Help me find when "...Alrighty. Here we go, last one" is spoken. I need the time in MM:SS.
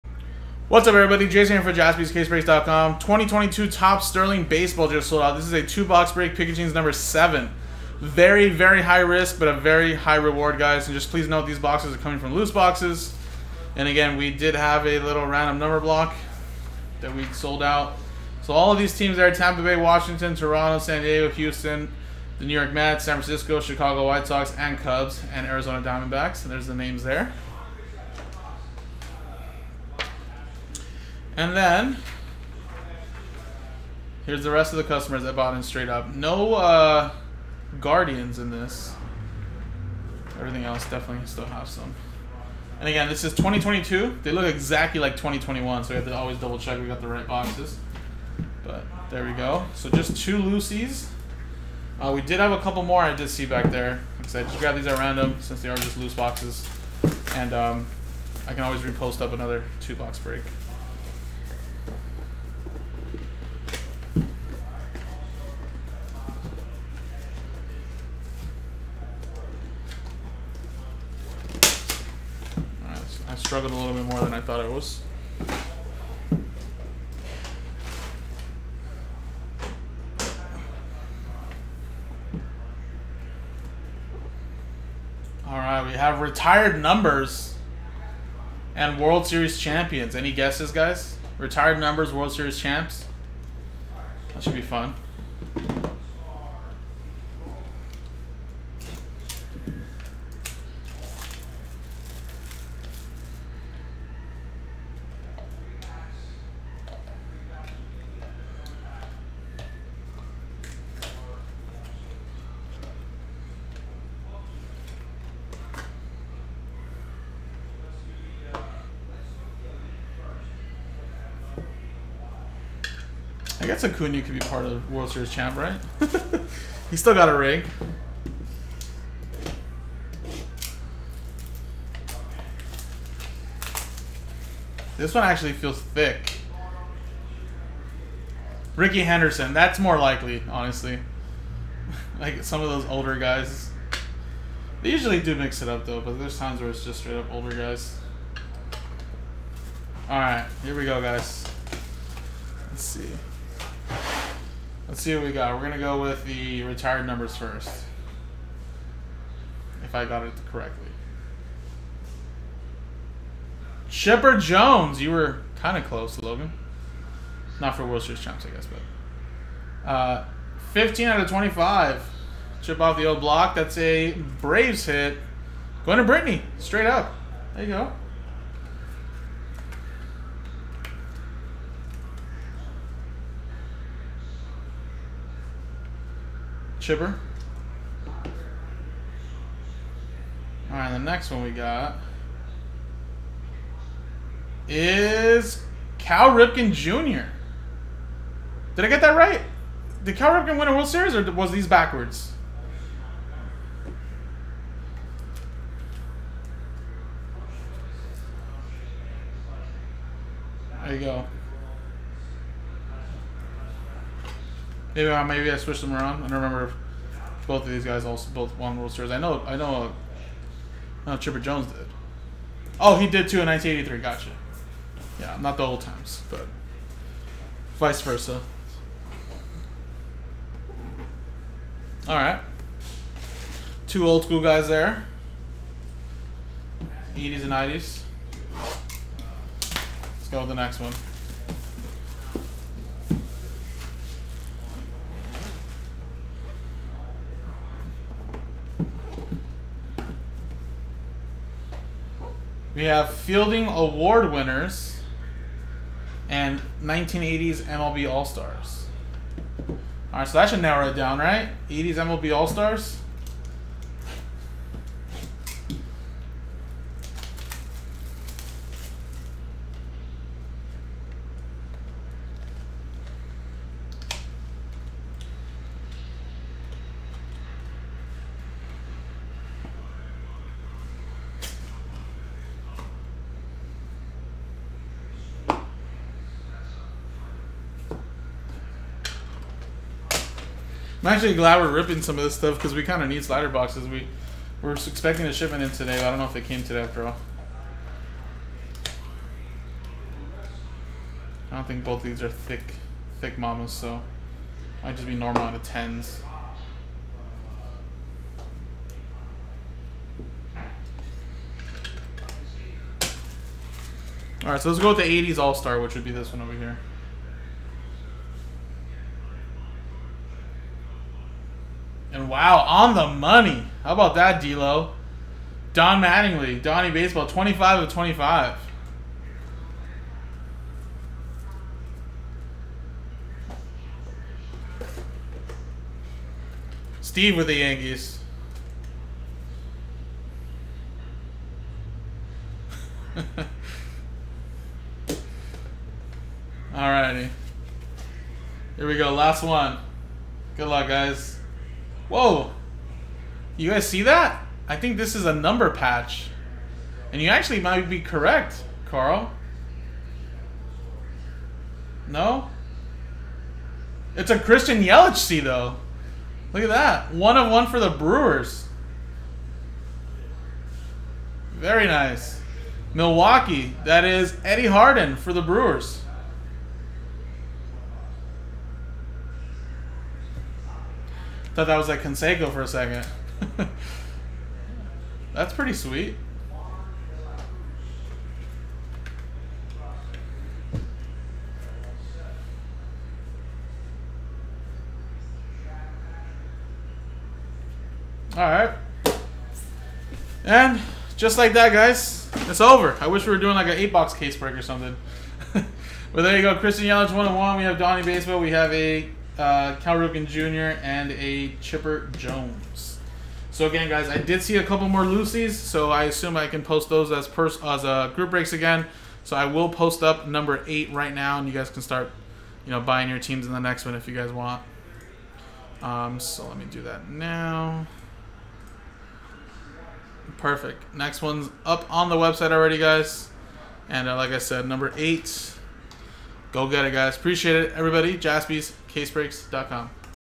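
05:46.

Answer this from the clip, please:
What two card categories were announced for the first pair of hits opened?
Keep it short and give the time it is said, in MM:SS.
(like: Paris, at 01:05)
Retired numbers and World Series champions, at 01:26.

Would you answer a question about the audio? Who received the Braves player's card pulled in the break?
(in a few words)
Brittany.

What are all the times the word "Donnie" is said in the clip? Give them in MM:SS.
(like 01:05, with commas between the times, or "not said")
05:26, 06:47.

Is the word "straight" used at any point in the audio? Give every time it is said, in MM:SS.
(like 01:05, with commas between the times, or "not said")
00:35, 02:26, 02:56.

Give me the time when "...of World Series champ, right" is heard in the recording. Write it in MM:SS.
02:04.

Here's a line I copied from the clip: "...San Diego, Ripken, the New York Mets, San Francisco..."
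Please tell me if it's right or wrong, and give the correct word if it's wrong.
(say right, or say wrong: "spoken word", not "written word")
wrong: "Houston", not "Ripken".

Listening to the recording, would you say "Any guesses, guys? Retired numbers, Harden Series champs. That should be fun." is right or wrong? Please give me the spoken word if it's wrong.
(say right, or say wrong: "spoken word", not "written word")
wrong: "World", not "Harden".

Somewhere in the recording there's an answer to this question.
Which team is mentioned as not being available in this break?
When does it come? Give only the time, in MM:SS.
00:37.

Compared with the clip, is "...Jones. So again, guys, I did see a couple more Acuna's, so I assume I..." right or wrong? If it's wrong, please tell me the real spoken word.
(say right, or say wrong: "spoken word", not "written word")
wrong: "Lucy", not "Acuna".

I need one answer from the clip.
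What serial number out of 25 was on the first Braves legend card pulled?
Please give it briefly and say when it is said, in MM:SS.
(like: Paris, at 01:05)
15, at 02:50.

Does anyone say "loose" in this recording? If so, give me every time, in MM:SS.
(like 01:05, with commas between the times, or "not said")
00:12, 00:55.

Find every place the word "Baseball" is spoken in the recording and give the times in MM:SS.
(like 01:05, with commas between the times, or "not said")
00:04, 05:26, 06:48.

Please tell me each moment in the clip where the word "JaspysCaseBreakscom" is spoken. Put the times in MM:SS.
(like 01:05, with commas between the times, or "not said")
00:01, 07:18.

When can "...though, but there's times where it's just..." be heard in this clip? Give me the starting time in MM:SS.
02:25.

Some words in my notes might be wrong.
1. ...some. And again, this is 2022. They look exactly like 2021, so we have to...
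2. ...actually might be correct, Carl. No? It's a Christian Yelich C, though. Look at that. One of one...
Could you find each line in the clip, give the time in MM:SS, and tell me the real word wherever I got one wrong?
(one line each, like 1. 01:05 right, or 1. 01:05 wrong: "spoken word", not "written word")
1. 00:41 right
2. 05:57 right.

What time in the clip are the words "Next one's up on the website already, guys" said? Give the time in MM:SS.
07:10.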